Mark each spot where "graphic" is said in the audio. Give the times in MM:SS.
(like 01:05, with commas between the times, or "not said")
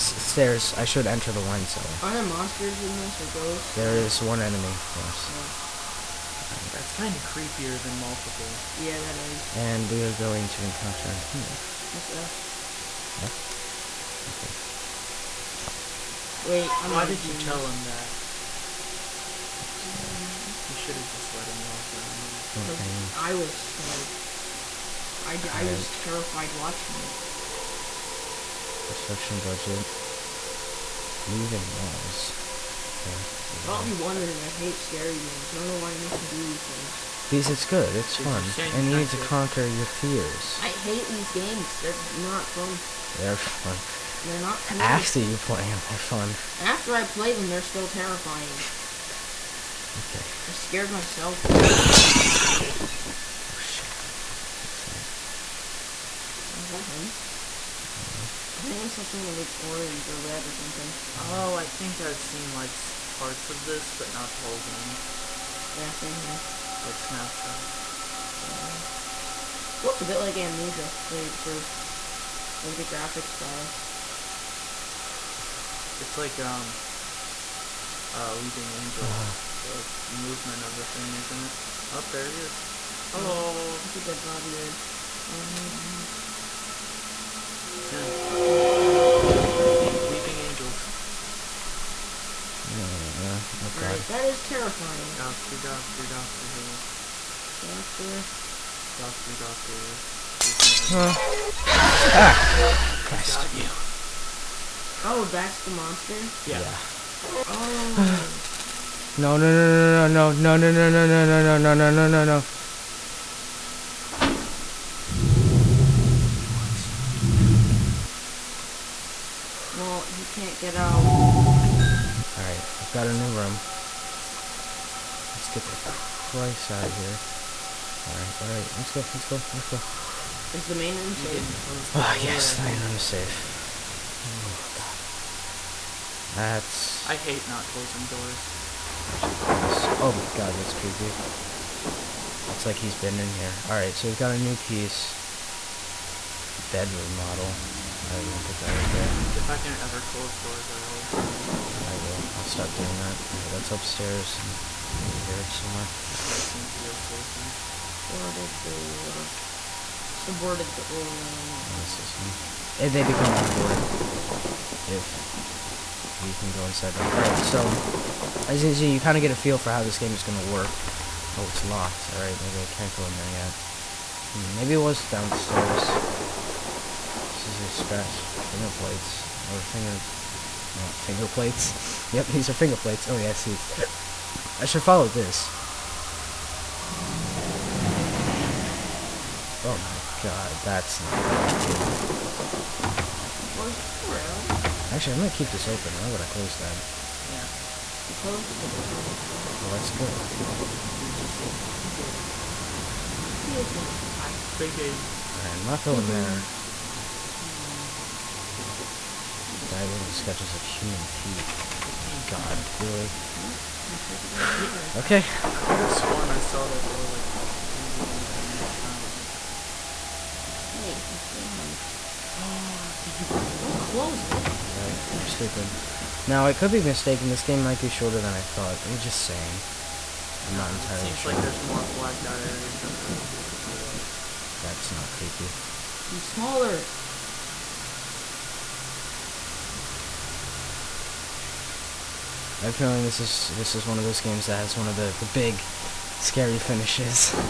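01:12.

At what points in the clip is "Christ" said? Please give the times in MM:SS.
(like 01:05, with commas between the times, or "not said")
01:43, 02:05.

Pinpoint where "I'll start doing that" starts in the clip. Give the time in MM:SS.
02:32.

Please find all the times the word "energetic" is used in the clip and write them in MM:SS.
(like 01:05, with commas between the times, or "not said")
not said.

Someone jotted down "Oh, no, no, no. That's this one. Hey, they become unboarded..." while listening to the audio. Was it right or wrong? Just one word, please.
right.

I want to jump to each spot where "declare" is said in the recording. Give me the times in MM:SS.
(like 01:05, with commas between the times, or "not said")
not said.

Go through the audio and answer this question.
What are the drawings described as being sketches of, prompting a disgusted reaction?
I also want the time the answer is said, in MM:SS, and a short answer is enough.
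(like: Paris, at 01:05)
human teeth, at 03:30.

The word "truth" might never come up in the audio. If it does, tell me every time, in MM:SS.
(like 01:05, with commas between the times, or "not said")
01:11.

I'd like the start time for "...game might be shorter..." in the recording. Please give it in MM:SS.
03:47.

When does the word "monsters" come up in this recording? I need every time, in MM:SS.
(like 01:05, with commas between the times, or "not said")
00:02, 01:45.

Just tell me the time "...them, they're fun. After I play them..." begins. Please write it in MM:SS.
00:45.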